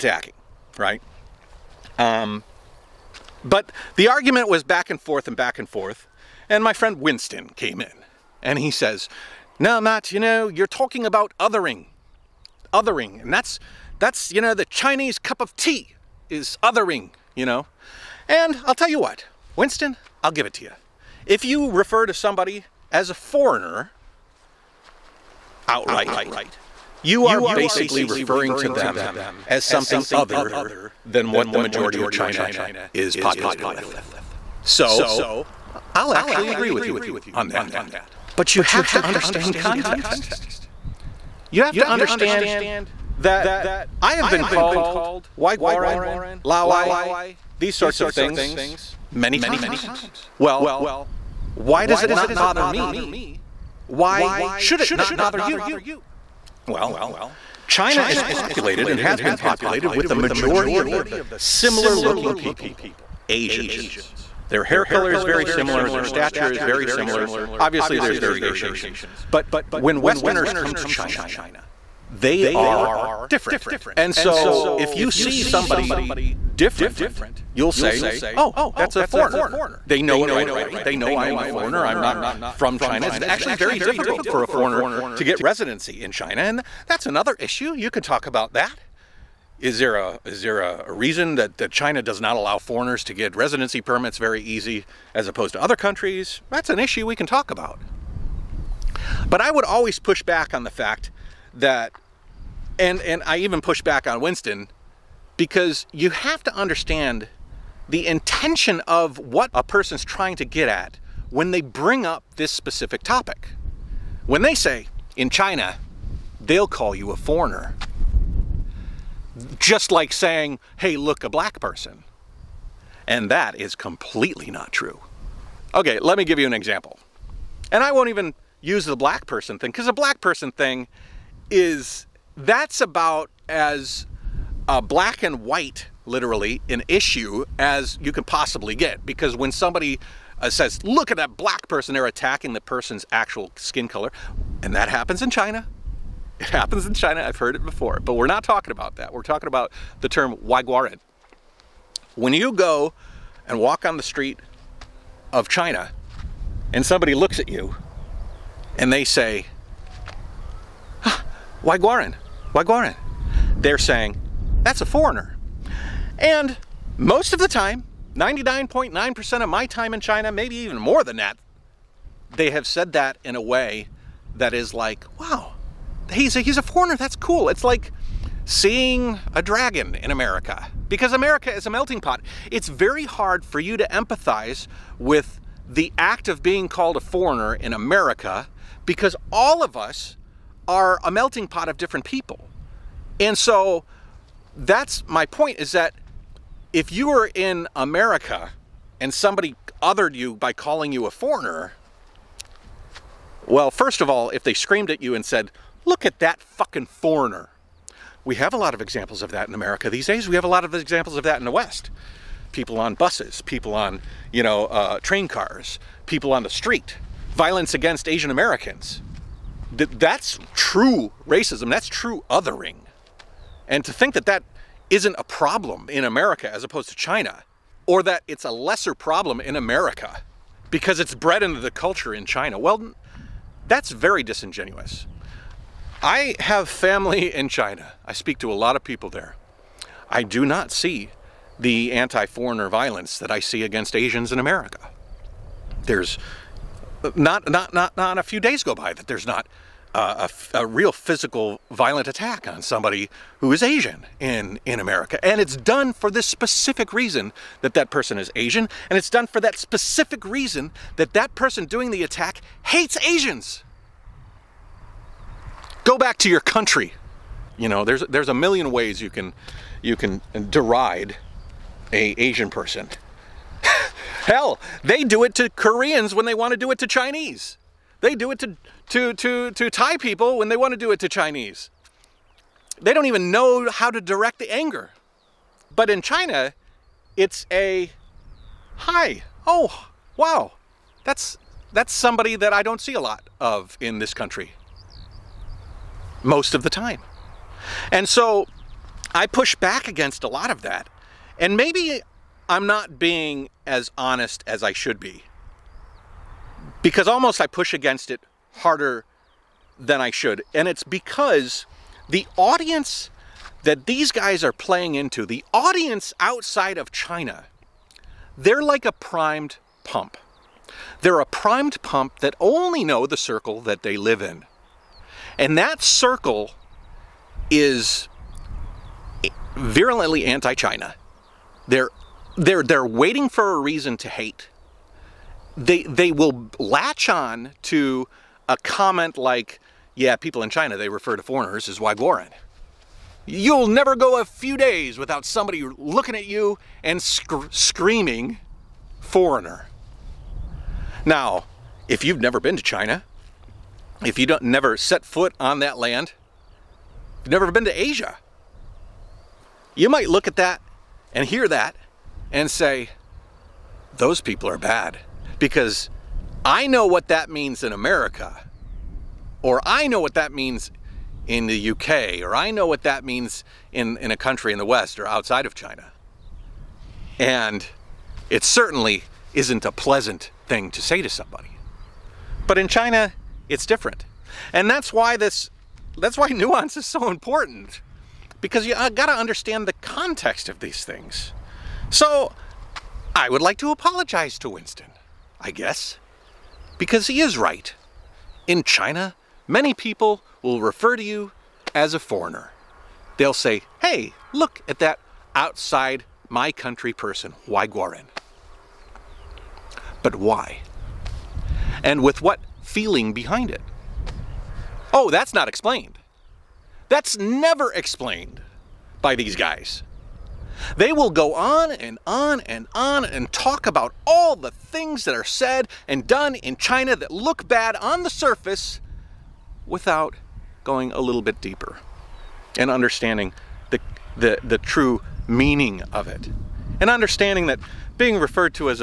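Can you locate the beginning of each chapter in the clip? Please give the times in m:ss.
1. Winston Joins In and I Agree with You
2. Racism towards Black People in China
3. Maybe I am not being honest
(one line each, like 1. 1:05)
1. 0:07
2. 2:24
3. 5:00.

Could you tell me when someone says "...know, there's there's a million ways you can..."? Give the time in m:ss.
4:27.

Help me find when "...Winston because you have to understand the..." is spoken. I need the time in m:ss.
1:44.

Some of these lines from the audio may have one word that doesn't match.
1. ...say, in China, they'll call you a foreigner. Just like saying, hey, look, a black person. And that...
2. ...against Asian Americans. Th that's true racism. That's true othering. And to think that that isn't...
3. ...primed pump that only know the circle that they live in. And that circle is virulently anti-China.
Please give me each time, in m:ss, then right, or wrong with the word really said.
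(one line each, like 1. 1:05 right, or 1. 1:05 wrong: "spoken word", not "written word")
1. 1:54 right
2. 3:37 right
3. 5:21 right.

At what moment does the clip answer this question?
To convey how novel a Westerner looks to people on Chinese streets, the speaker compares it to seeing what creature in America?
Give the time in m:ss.
2:59.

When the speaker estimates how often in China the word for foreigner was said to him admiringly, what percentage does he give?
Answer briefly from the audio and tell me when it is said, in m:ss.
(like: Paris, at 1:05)
99.9%, at 2:48.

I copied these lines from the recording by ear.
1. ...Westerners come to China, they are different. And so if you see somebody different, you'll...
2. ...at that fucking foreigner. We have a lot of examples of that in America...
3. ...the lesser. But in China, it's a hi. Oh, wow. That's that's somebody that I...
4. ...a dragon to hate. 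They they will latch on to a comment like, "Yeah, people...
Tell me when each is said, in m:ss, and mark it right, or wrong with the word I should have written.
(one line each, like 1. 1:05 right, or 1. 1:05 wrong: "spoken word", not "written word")
1. 1:10 right
2. 3:26 right
3. 4:44 wrong: "anger", not "lesser"
4. 5:33 wrong: "reason", not "dragon".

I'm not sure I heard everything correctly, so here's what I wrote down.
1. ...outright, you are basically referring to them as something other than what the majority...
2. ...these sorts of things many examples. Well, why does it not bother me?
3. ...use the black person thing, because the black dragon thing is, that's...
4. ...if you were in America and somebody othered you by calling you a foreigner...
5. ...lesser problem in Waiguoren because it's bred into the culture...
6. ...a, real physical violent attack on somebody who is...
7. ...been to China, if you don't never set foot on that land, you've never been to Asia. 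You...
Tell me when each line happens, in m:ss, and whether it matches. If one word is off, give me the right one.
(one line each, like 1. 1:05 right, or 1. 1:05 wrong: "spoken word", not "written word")
1. 0:25 right
2. 0:47 wrong: "times", not "examples"
3. 2:08 wrong: "person", not "dragon"
4. 3:16 right
5. 3:48 wrong: "America", not "Waiguoren"
6. 4:10 right
7. 5:52 right.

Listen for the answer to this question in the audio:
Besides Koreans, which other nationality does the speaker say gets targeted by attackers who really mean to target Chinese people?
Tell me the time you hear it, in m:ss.
4:39.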